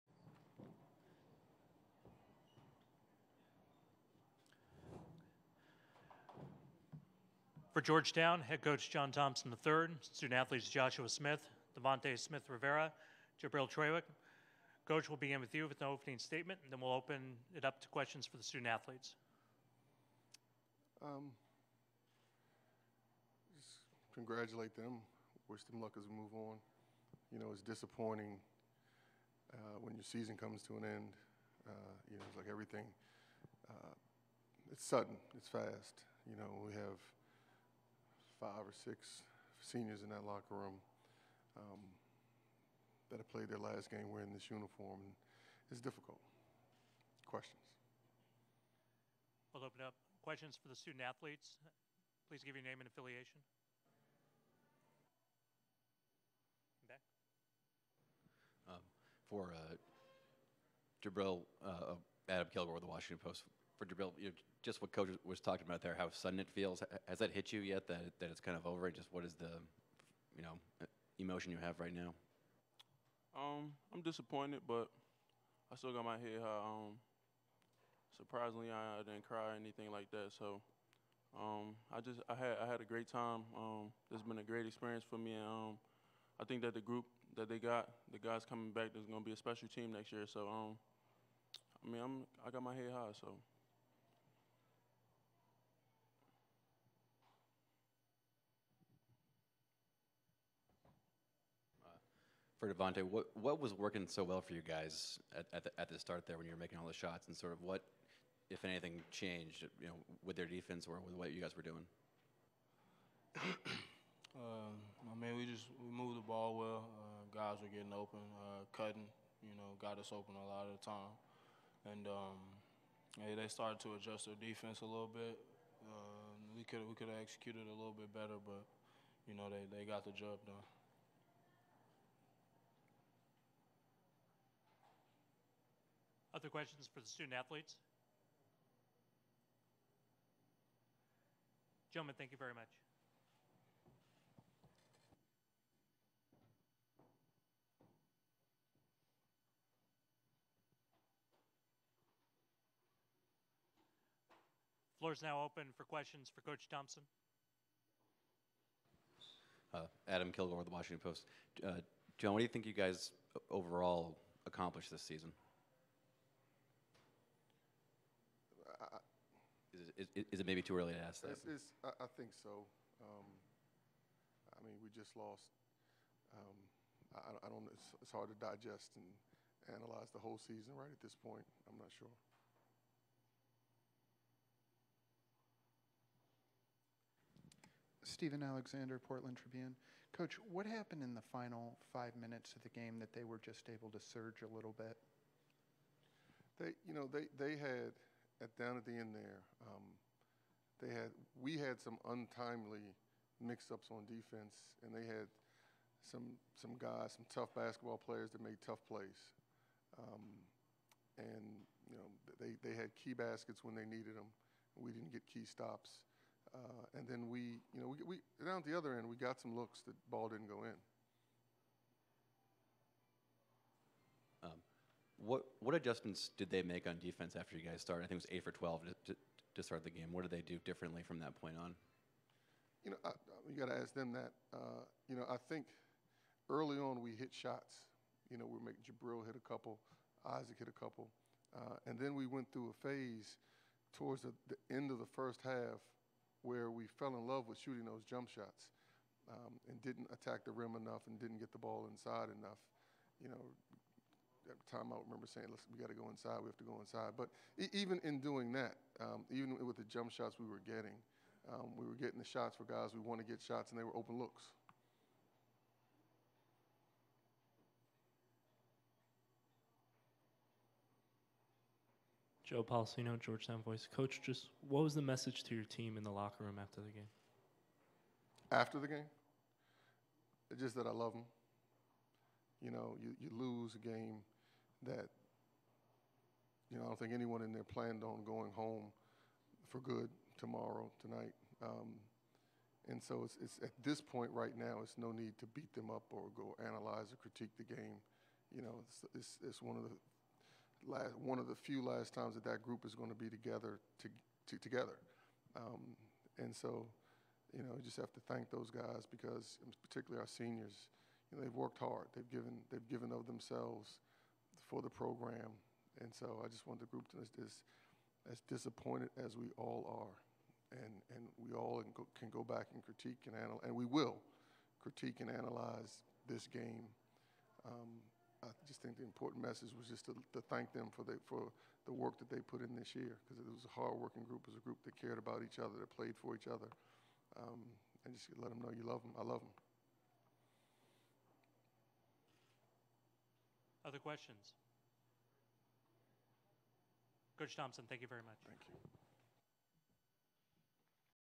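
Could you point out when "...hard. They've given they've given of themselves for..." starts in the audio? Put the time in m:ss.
5:11.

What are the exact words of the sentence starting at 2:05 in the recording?
Um, we could we could have executed a little bit better, but you know they, they got the job done.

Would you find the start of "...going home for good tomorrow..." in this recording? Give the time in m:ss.
4:48.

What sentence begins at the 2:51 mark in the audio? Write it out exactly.
It's, it's, I, I, think so.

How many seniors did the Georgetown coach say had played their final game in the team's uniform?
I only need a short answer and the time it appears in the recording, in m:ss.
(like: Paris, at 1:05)
5 or 6, at 0:38.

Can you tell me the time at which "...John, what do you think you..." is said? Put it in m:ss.
2:42.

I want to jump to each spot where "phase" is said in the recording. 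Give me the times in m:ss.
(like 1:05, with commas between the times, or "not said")
4:02.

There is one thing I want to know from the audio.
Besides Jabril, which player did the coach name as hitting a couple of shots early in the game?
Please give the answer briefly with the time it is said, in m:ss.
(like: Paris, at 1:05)
Isaac, at 4:00.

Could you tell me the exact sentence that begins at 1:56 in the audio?
Uh, guys were getting open, uh, cutting.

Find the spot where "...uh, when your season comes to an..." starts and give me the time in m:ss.
0:29.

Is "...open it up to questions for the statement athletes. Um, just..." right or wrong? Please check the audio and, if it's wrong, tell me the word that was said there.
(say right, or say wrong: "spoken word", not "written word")
wrong: "student", not "statement".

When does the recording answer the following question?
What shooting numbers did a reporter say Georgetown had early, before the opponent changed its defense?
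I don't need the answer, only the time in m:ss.
3:48.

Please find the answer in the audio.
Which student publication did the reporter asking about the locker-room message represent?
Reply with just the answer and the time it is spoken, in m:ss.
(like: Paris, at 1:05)
Georgetown Voice, at 4:33.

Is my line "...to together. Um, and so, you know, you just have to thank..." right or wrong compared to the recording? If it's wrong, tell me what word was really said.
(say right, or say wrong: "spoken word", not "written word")
right.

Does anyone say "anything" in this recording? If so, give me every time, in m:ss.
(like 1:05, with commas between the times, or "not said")
1:19, 1:48.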